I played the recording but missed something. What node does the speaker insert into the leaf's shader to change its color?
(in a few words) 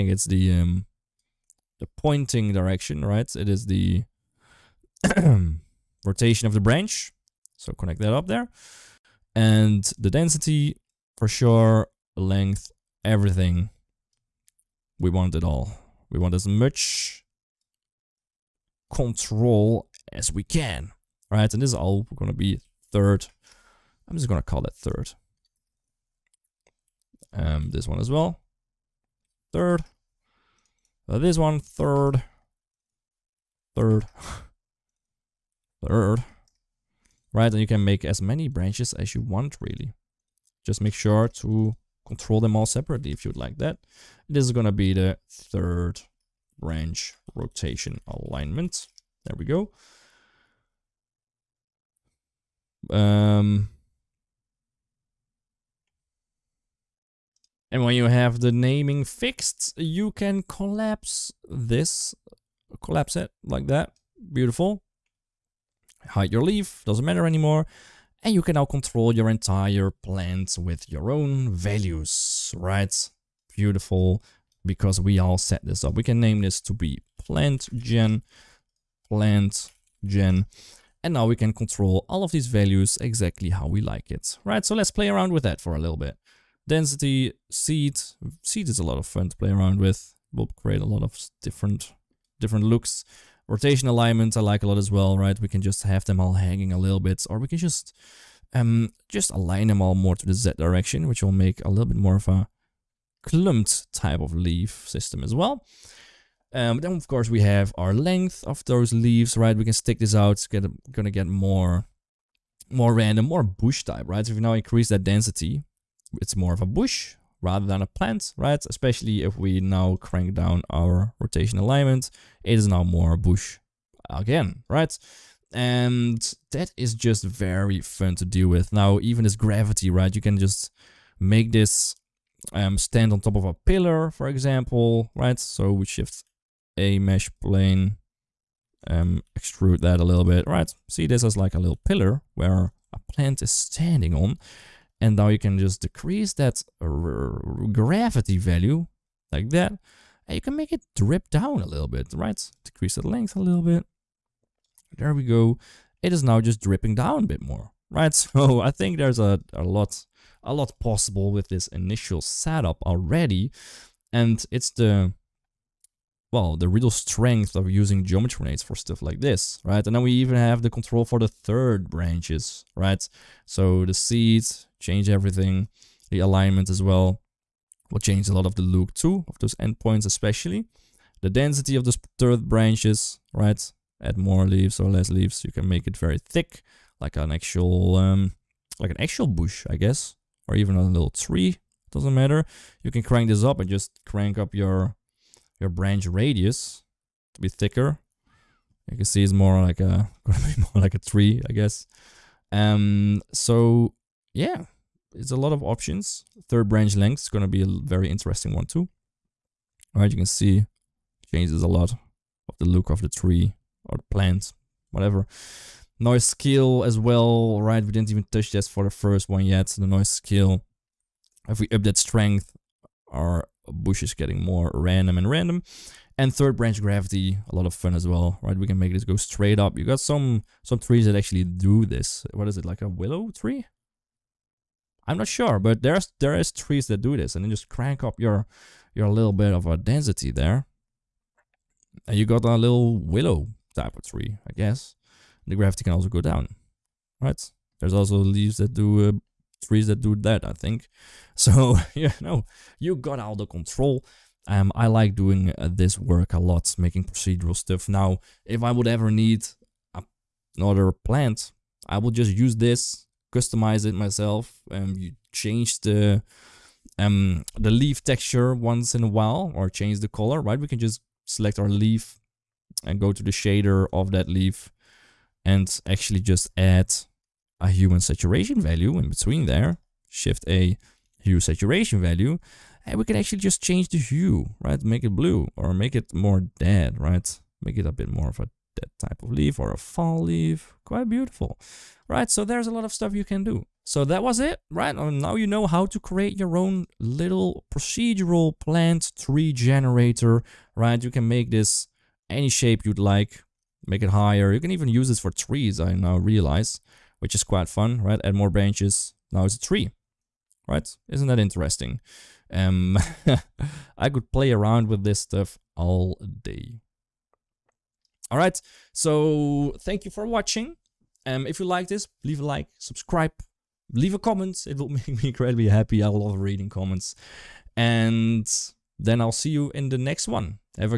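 hue and saturation value.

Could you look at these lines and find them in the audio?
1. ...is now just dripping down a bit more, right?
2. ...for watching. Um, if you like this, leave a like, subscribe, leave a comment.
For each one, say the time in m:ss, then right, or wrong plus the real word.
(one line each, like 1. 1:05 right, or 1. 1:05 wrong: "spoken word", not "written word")
1. 2:36 right
2. 5:20 right.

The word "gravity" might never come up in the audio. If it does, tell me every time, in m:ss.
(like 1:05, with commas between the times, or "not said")
2:09, 2:27, 3:46, 4:05.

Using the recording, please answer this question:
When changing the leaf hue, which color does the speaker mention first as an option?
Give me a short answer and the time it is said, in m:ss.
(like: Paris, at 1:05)
blue, at 4:45.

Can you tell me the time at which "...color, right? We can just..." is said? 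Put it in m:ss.
4:30.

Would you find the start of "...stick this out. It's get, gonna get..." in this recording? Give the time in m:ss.
1:49.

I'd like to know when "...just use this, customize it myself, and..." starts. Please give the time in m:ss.
4:22.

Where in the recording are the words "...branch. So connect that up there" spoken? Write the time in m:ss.
0:06.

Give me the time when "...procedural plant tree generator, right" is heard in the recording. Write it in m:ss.
4:57.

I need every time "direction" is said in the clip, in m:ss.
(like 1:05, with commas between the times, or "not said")
0:02, 1:40.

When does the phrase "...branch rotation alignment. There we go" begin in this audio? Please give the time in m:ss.
0:46.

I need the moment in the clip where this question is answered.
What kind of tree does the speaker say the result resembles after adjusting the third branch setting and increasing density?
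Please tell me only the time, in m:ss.
3:52.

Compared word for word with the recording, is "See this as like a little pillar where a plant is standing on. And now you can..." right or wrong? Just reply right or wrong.
right.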